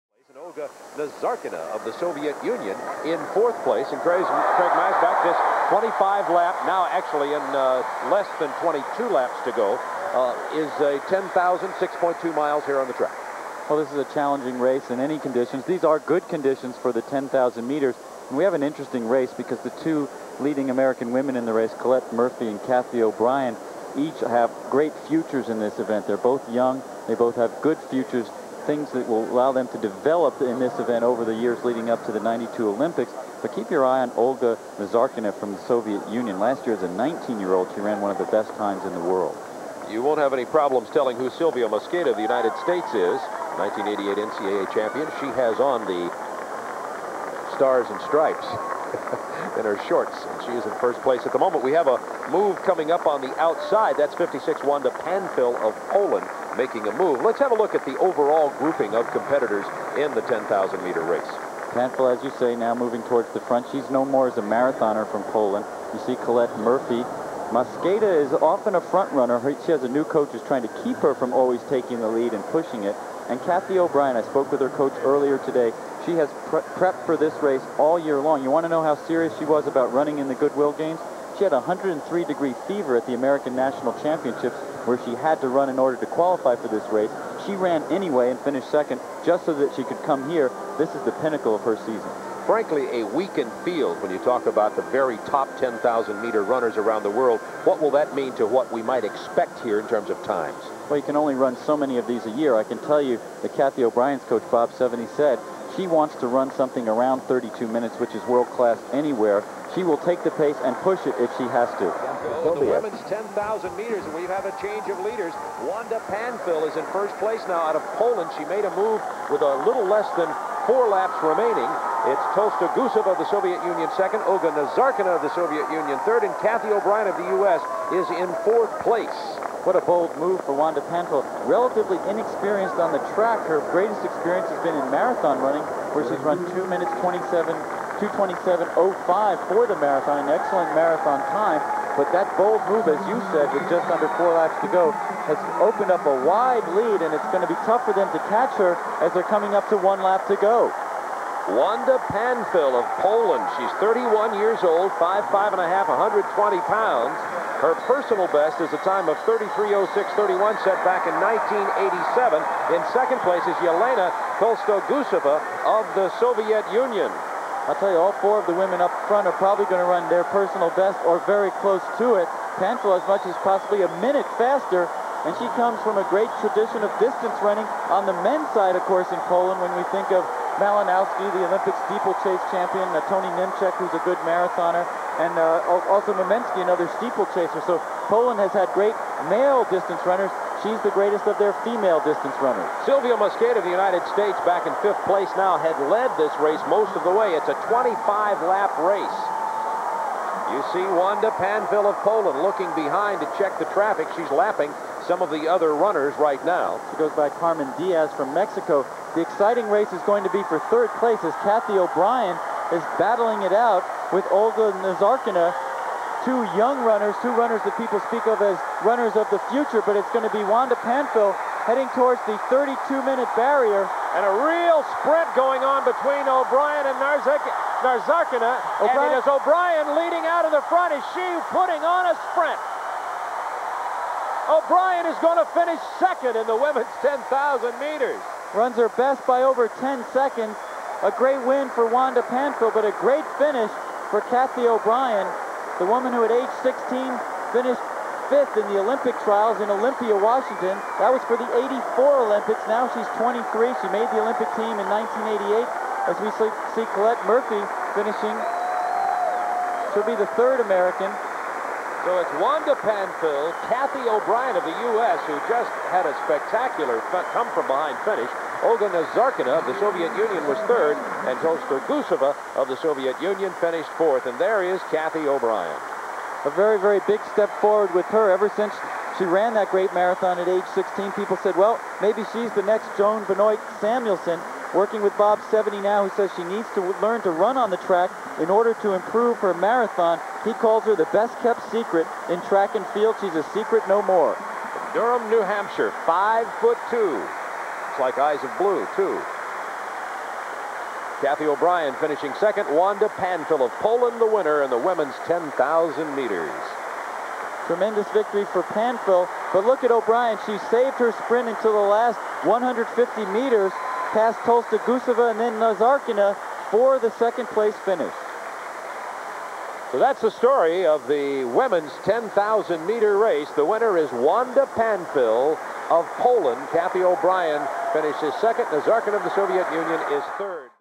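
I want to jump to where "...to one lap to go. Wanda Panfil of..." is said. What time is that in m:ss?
2:29.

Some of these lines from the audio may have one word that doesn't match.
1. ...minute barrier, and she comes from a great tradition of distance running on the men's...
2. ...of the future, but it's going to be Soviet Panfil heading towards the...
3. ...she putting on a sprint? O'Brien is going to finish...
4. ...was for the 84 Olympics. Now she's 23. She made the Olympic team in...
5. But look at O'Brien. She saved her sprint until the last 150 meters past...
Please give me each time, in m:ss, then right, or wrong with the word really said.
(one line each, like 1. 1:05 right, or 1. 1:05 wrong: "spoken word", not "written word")
1. 2:54 wrong: "faster", not "barrier"
2. 3:39 wrong: "Wanda", not "Soviet"
3. 3:51 right
4. 4:11 right
5. 5:09 right.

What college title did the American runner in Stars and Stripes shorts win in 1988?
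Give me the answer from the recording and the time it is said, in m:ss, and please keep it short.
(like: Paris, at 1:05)
NCAA champion, at 0:43.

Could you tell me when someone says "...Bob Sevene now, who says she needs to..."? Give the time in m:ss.
4:45.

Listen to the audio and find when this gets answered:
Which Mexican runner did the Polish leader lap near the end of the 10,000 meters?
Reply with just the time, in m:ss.
3:27.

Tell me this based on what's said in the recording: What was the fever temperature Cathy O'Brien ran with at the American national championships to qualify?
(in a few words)
103 degrees.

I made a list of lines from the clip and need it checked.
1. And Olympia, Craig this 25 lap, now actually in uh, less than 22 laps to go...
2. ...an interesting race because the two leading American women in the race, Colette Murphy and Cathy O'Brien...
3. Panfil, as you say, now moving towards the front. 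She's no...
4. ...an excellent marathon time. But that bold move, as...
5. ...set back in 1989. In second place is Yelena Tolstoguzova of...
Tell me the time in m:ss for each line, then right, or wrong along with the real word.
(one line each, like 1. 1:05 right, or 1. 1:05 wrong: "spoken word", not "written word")
1. 0:03 wrong: "Craig", not "Olympia"
2. 0:18 right
3. 1:01 right
4. 2:20 right
5. 2:40 wrong: "1987", not "1989".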